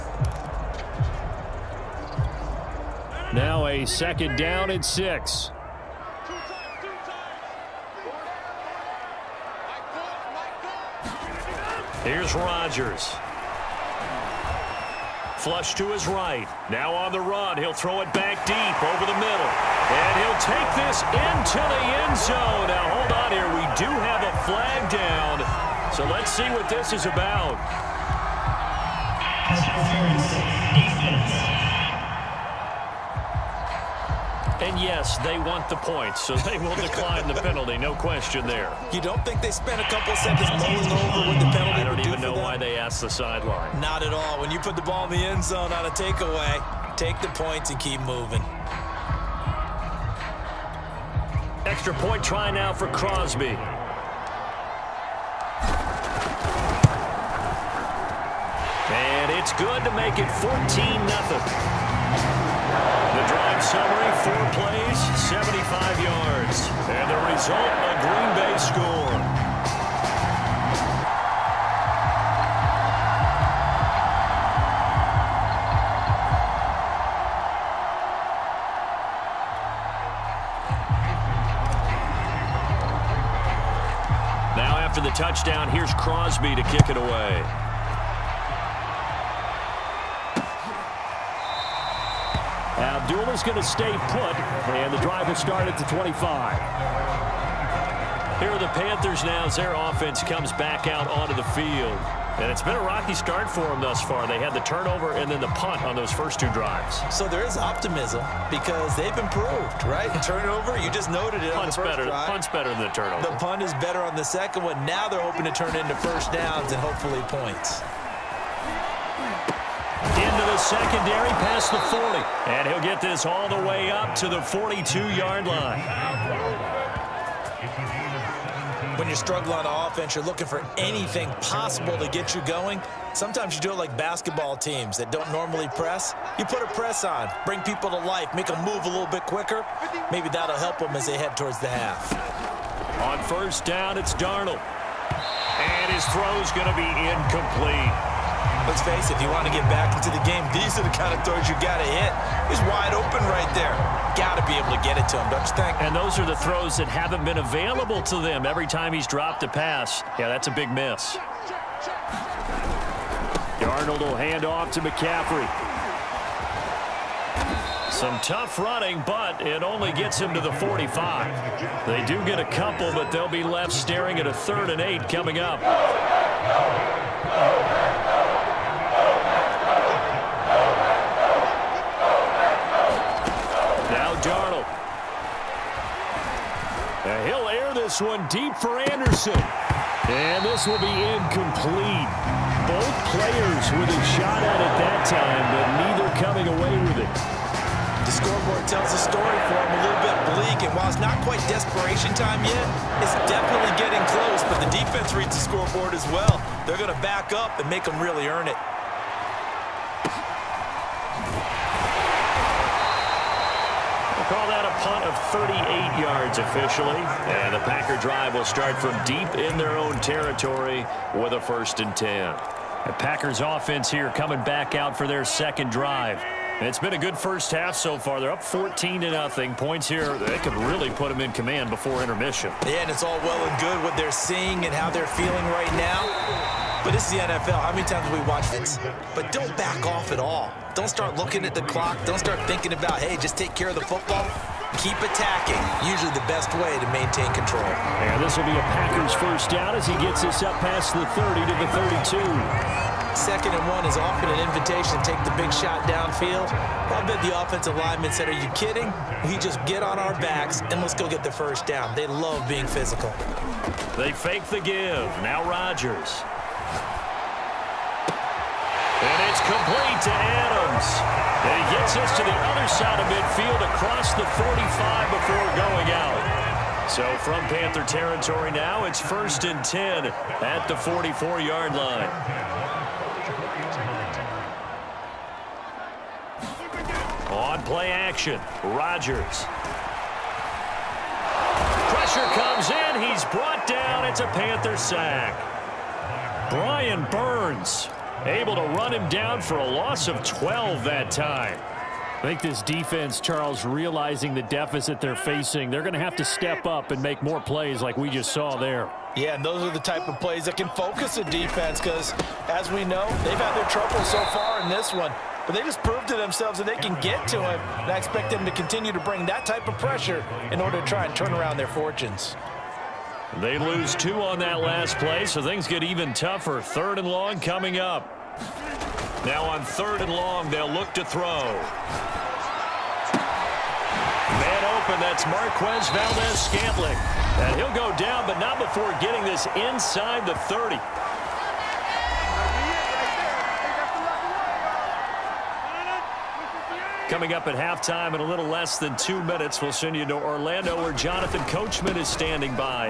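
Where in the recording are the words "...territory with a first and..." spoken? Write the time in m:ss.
3:40.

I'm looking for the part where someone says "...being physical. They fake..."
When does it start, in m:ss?
4:22.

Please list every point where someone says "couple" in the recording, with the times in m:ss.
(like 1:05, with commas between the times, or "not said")
0:39, 2:52.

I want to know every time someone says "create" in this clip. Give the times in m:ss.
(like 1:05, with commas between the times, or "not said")
not said.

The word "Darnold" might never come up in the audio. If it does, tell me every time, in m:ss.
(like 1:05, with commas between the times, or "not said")
2:24, 2:43.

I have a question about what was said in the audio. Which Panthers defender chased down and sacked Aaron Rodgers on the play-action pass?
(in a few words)
Brian Burns.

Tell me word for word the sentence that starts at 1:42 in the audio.
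And it's been a rocky start for them thus far.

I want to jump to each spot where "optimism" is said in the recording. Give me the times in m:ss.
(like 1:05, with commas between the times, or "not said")
1:47.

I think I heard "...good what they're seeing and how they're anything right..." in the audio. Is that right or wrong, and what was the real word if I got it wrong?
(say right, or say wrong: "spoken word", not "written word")
wrong: "feeling", not "anything".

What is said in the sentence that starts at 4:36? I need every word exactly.
So from Panther territory now, it's first and 10 at the 44-yard line.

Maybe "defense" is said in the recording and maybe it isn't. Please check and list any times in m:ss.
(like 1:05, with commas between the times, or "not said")
3:24, 5:02, 5:11.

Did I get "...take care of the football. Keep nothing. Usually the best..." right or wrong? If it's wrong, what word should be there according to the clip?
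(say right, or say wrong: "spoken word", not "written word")
wrong: "attacking", not "nothing".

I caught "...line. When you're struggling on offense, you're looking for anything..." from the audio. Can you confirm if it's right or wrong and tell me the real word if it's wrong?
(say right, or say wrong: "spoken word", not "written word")
right.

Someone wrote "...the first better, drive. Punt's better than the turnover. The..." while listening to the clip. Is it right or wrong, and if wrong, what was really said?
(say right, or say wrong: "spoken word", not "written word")
right.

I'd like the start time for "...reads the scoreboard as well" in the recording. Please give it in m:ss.
3:25.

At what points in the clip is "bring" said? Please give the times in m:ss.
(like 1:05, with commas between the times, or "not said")
2:17, 5:18.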